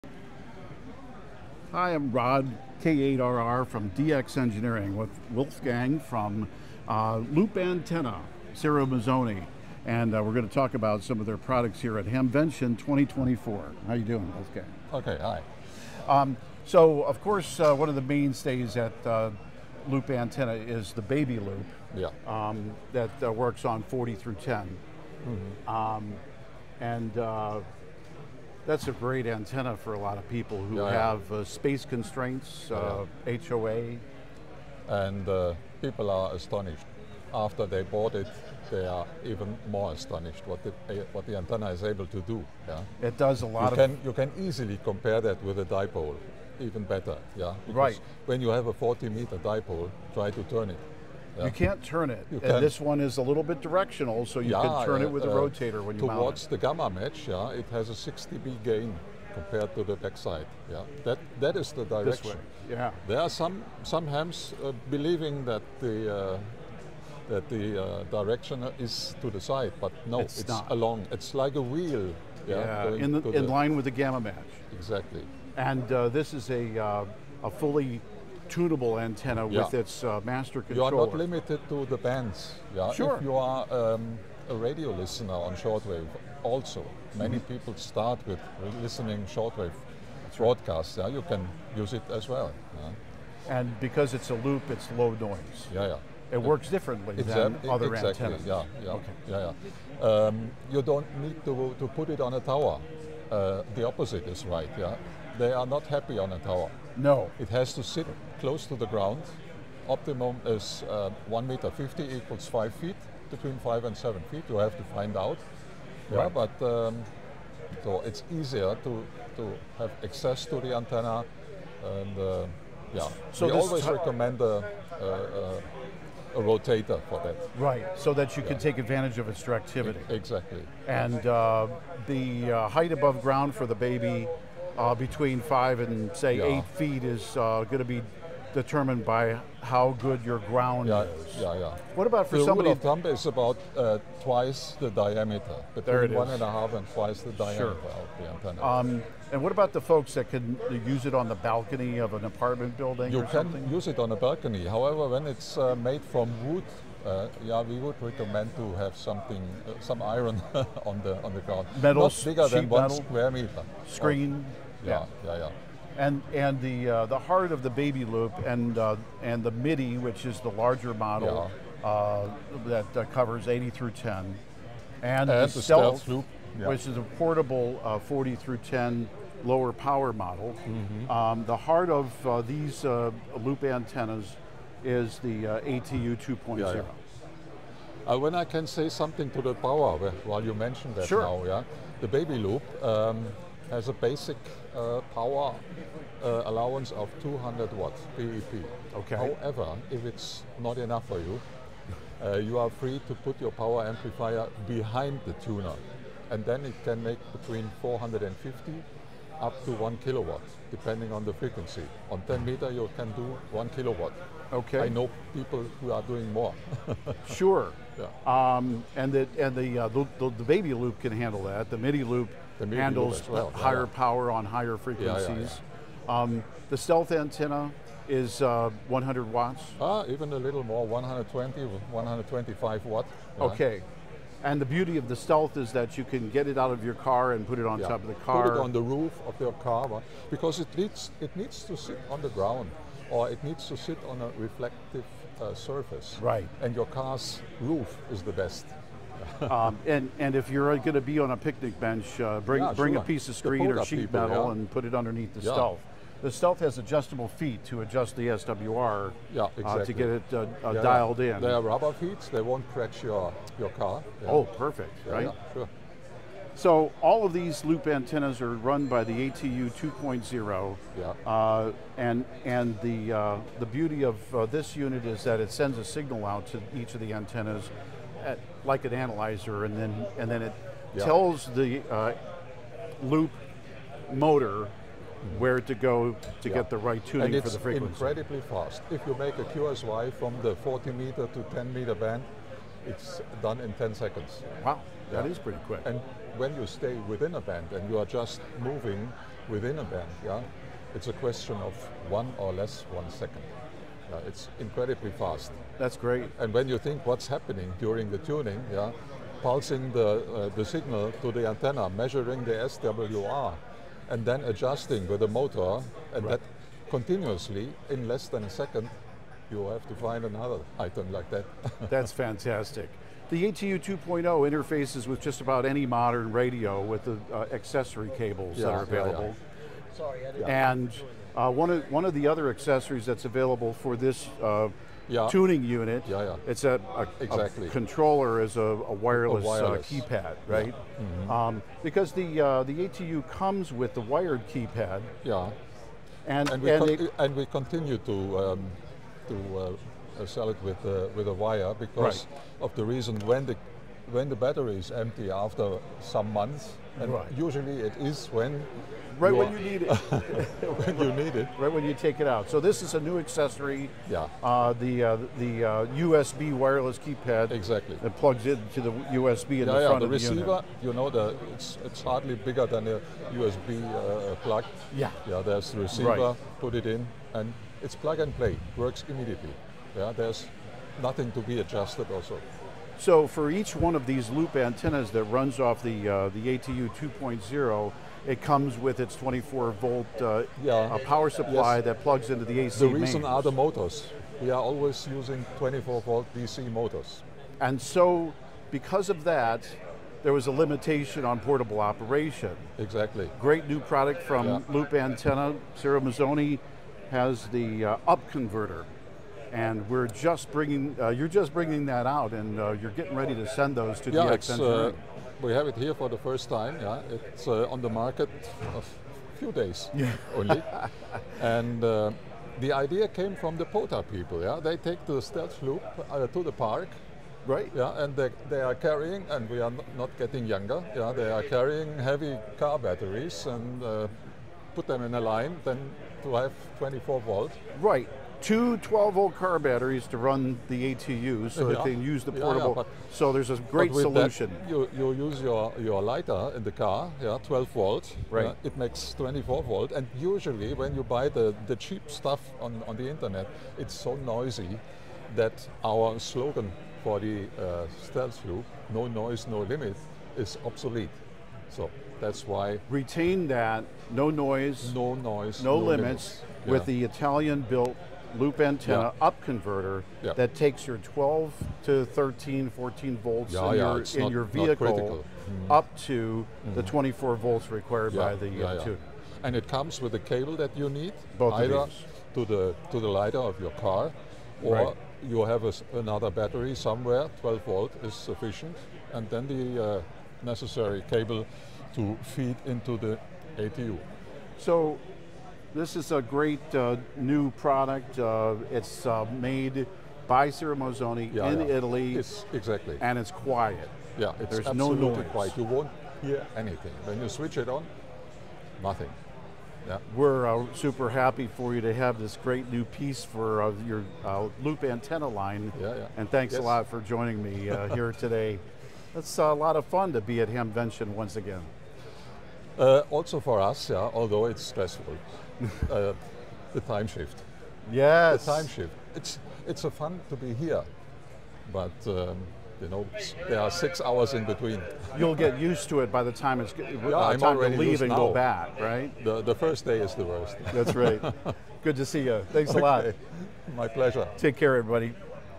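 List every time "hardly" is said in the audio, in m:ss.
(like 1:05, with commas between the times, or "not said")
6:12.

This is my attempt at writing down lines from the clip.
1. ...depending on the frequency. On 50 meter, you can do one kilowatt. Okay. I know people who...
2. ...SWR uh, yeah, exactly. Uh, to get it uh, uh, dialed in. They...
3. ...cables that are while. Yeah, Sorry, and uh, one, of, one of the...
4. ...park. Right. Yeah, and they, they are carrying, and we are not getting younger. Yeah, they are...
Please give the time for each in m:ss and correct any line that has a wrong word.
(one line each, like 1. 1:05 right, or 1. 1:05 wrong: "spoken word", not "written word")
1. 3:30 wrong: "10", not "50"
2. 4:18 right
3. 5:28 wrong: "available", not "while"
4. 7:06 right.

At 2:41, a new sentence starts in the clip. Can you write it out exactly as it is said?
Metal, Not bigger than metal, one square meter.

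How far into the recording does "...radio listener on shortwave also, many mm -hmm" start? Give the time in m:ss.
1:24.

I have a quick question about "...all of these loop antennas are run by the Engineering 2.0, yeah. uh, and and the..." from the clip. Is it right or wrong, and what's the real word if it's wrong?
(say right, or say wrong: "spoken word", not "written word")
wrong: "ATU", not "Engineering".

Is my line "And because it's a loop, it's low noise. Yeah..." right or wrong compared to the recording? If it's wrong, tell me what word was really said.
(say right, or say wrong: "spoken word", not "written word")
right.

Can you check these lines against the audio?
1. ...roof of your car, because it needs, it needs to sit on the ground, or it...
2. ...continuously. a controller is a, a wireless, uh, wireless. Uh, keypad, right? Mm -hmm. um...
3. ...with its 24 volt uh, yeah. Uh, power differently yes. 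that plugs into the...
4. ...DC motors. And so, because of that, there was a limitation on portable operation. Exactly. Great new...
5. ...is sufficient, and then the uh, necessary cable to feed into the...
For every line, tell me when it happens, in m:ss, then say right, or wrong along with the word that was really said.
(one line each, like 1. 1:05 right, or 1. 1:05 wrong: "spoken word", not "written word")
1. 3:58 right
2. 5:37 wrong: "exactly", not "continuously"
3. 6:28 wrong: "supply", not "differently"
4. 6:36 right
5. 8:08 right.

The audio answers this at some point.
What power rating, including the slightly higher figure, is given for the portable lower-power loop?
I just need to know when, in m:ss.
3:50.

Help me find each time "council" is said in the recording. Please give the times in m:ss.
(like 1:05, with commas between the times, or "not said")
not said.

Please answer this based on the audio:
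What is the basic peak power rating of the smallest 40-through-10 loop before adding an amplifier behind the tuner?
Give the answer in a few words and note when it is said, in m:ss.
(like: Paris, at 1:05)
200 watts PEP, at 3:17.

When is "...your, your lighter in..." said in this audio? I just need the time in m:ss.
7:25.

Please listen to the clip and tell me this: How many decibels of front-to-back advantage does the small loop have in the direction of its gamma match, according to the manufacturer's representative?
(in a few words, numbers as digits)
60 dB.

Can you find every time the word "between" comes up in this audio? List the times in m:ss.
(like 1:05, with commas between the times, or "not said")
1:53, 2:14, 2:25, 3:27, 8:54.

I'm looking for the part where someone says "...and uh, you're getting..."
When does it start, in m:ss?
6:52.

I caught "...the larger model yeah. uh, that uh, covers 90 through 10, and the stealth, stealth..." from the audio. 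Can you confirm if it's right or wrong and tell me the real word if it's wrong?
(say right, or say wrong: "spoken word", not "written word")
wrong: "80", not "90".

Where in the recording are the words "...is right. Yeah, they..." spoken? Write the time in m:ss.
1:44.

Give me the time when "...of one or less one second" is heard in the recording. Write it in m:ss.
5:01.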